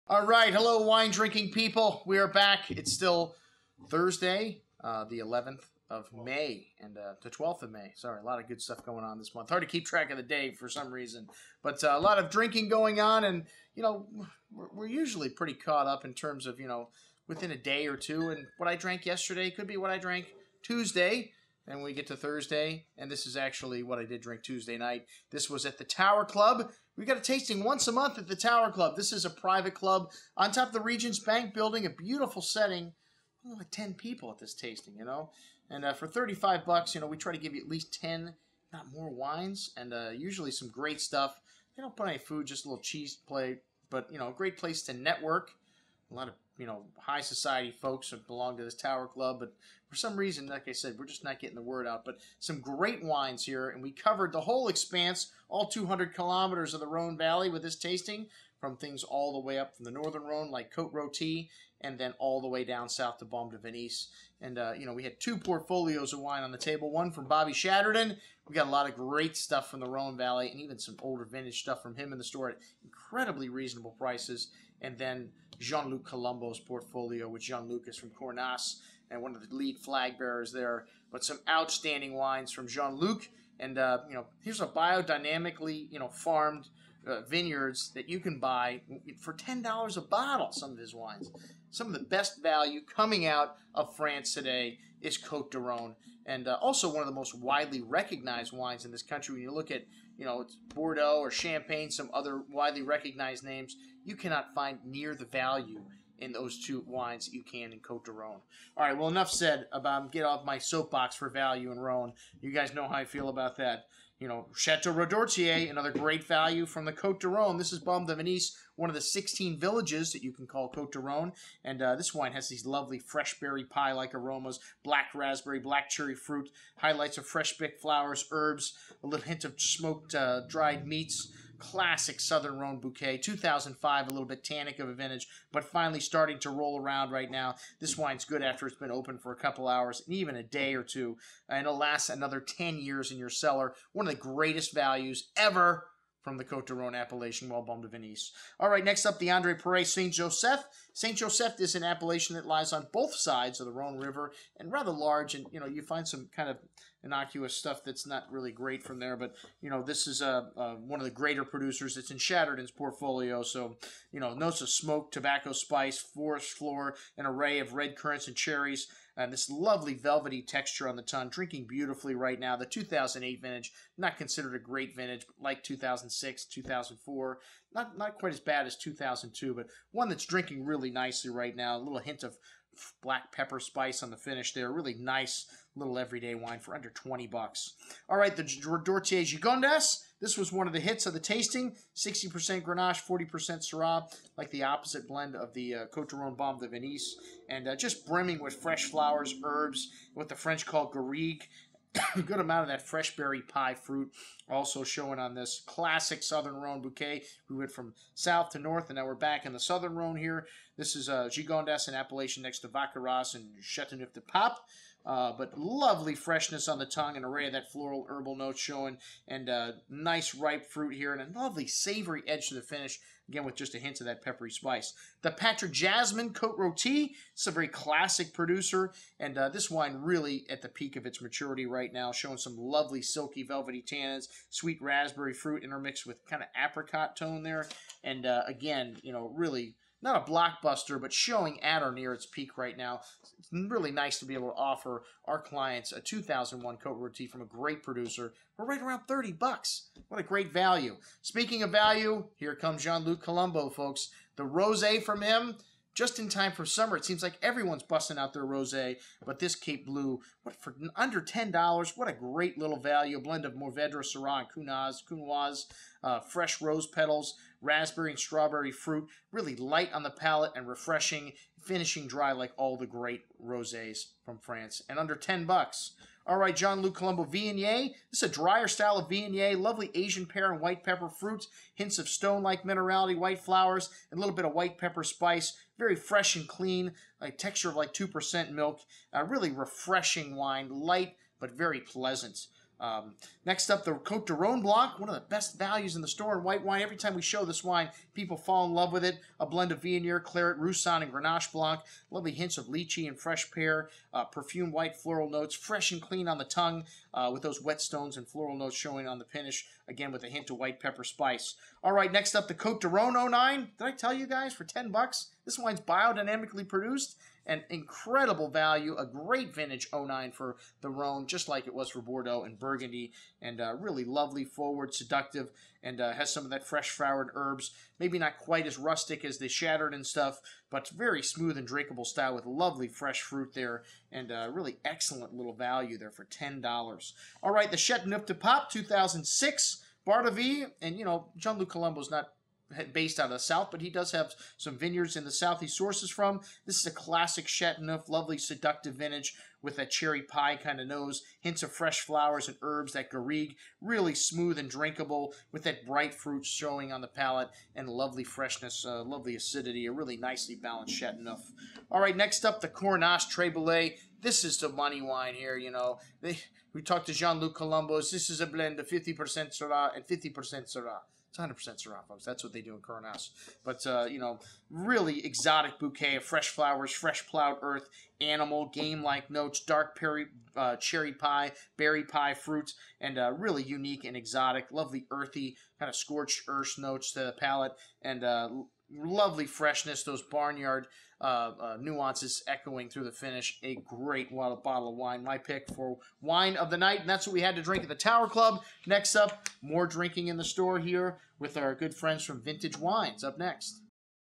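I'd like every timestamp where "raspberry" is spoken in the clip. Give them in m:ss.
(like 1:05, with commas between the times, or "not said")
2:05, 3:54, 4:27.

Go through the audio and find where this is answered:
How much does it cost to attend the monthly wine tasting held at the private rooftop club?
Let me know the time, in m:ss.
0:36.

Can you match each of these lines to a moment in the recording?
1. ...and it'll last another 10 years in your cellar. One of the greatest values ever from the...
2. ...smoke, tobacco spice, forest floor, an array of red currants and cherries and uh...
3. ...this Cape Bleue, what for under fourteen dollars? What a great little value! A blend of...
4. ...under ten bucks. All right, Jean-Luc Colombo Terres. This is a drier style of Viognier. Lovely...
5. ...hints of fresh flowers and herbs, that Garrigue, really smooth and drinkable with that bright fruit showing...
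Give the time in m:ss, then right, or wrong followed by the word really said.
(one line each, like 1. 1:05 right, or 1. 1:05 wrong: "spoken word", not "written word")
1. 2:21 right
2. 2:44 right
3. 4:19 wrong: "ten", not "fourteen"
4. 4:34 wrong: "Viognier", not "Terres"
5. 5:51 right.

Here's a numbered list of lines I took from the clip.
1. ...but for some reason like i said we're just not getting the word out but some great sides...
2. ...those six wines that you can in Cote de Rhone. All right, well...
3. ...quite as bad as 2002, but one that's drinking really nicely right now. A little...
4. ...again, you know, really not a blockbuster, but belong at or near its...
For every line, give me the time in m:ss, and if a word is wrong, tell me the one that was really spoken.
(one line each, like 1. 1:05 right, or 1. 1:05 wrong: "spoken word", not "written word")
1. 0:49 wrong: "wines", not "sides"
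2. 1:46 wrong: "two", not "six"
3. 2:58 right
4. 3:58 wrong: "showing", not "belong".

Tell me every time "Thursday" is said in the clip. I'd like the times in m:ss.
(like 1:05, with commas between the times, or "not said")
0:03, 0:22.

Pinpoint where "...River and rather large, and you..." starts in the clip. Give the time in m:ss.
2:33.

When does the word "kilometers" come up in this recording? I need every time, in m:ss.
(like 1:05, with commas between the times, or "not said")
0:56.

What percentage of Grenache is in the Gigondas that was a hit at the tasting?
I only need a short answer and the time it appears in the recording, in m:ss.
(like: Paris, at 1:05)
60%, at 3:11.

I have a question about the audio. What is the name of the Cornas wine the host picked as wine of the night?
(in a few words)
Terres Brulees.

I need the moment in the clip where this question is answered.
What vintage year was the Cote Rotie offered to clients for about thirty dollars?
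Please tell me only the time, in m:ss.
4:06.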